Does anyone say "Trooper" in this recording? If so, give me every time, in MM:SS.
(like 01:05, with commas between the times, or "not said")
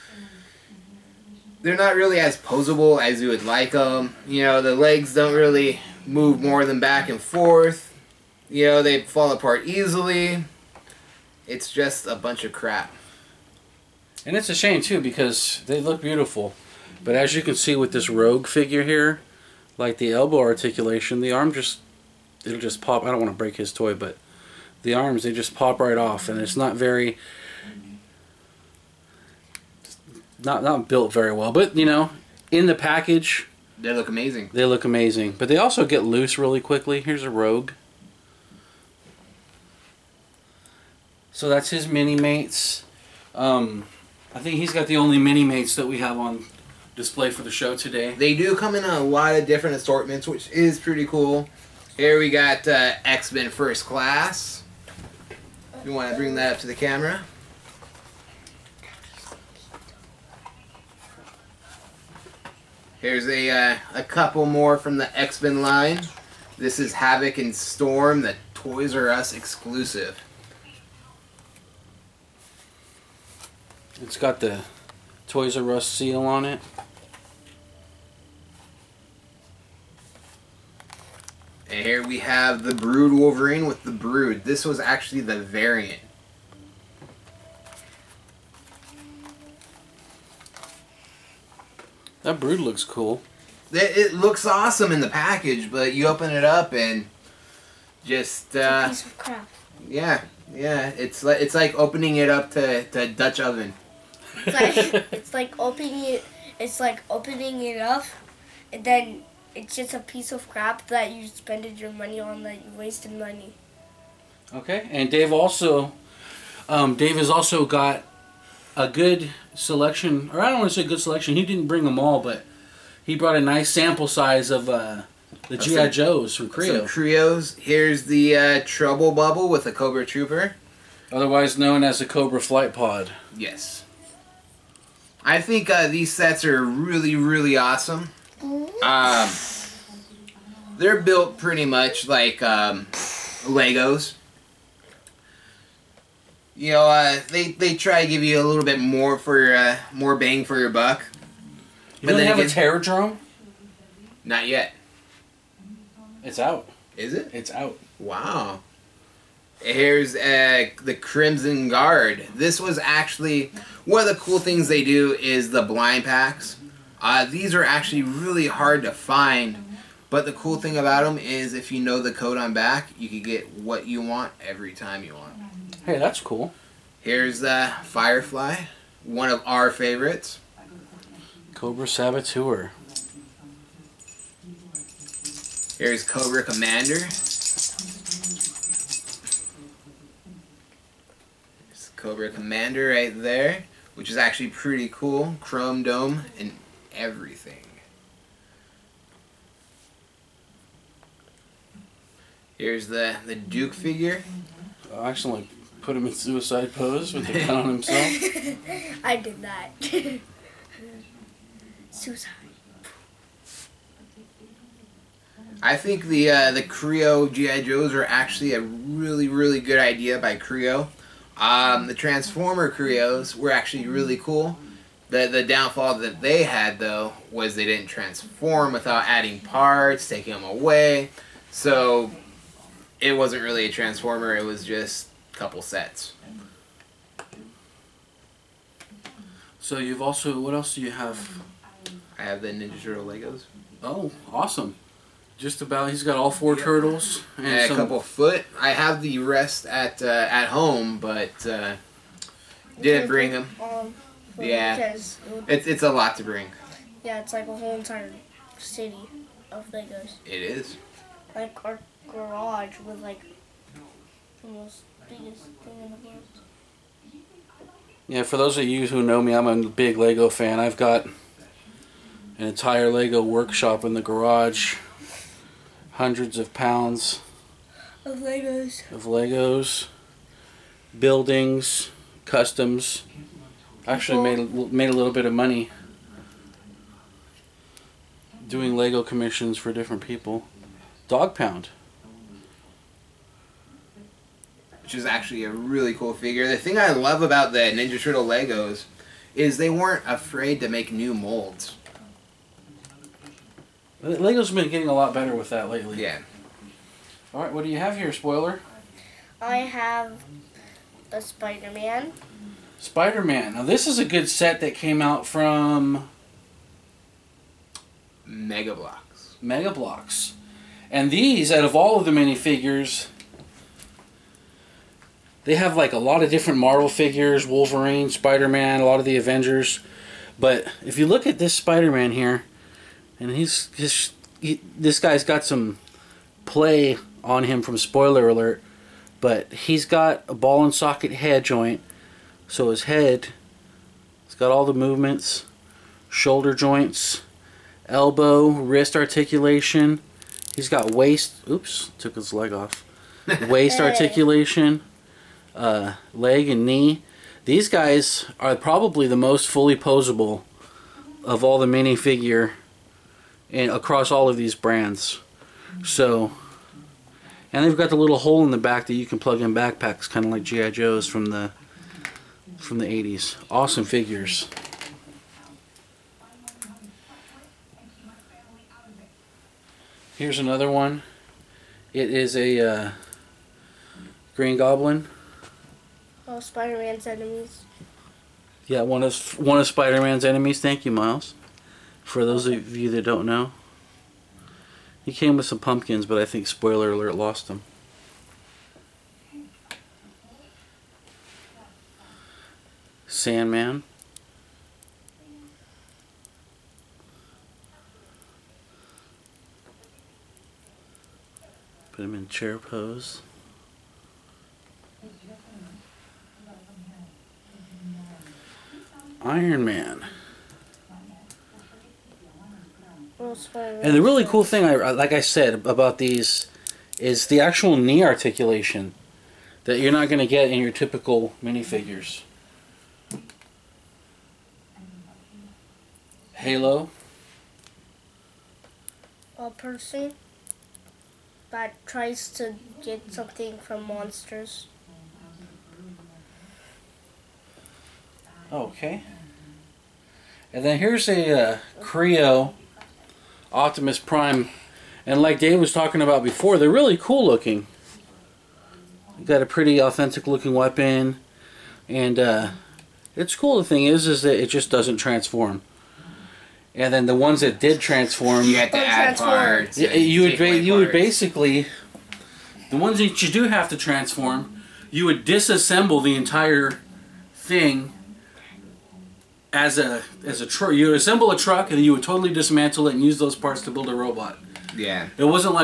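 02:10.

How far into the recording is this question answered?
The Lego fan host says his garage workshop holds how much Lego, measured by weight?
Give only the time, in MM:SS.
04:35.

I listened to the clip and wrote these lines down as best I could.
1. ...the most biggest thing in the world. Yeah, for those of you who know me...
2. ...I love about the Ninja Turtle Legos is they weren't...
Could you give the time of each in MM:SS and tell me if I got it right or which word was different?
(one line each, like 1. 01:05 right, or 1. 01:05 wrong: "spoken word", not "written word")
1. 04:24 right
2. 04:56 right.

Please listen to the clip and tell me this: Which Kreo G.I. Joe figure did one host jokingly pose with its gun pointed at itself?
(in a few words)
Duke.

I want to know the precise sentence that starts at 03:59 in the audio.
So you've also, what else do you have?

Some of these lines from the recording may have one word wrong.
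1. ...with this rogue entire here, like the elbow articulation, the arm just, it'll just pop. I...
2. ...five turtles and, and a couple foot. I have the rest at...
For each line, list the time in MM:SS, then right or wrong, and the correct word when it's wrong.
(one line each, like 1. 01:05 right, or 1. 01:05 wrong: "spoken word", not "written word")
1. 00:17 wrong: "figure", not "entire"
2. 04:06 wrong: "four", not "five".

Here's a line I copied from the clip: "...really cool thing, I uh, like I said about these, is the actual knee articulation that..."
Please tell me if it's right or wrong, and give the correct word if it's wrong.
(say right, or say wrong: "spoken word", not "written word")
right.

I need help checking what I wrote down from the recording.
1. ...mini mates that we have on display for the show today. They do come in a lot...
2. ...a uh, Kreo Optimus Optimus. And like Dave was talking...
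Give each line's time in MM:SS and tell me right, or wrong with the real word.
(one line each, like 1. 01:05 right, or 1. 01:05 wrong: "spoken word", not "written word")
1. 00:45 right
2. 07:31 wrong: "Prime", not "Optimus".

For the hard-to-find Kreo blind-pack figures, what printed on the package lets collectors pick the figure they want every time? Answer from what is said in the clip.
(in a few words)
The code on back.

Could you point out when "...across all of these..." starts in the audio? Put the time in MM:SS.
06:03.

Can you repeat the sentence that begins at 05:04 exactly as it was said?
Lego's been getting a lot better with that lately.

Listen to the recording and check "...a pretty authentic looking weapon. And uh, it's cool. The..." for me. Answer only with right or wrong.
right.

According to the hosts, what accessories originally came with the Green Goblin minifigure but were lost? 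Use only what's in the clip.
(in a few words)
Pumpkins.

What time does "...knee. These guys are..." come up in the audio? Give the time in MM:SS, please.
05:56.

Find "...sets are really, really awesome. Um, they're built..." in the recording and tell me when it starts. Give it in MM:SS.
02:16.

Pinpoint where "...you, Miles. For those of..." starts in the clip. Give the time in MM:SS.
06:30.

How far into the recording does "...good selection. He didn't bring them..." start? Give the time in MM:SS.
02:00.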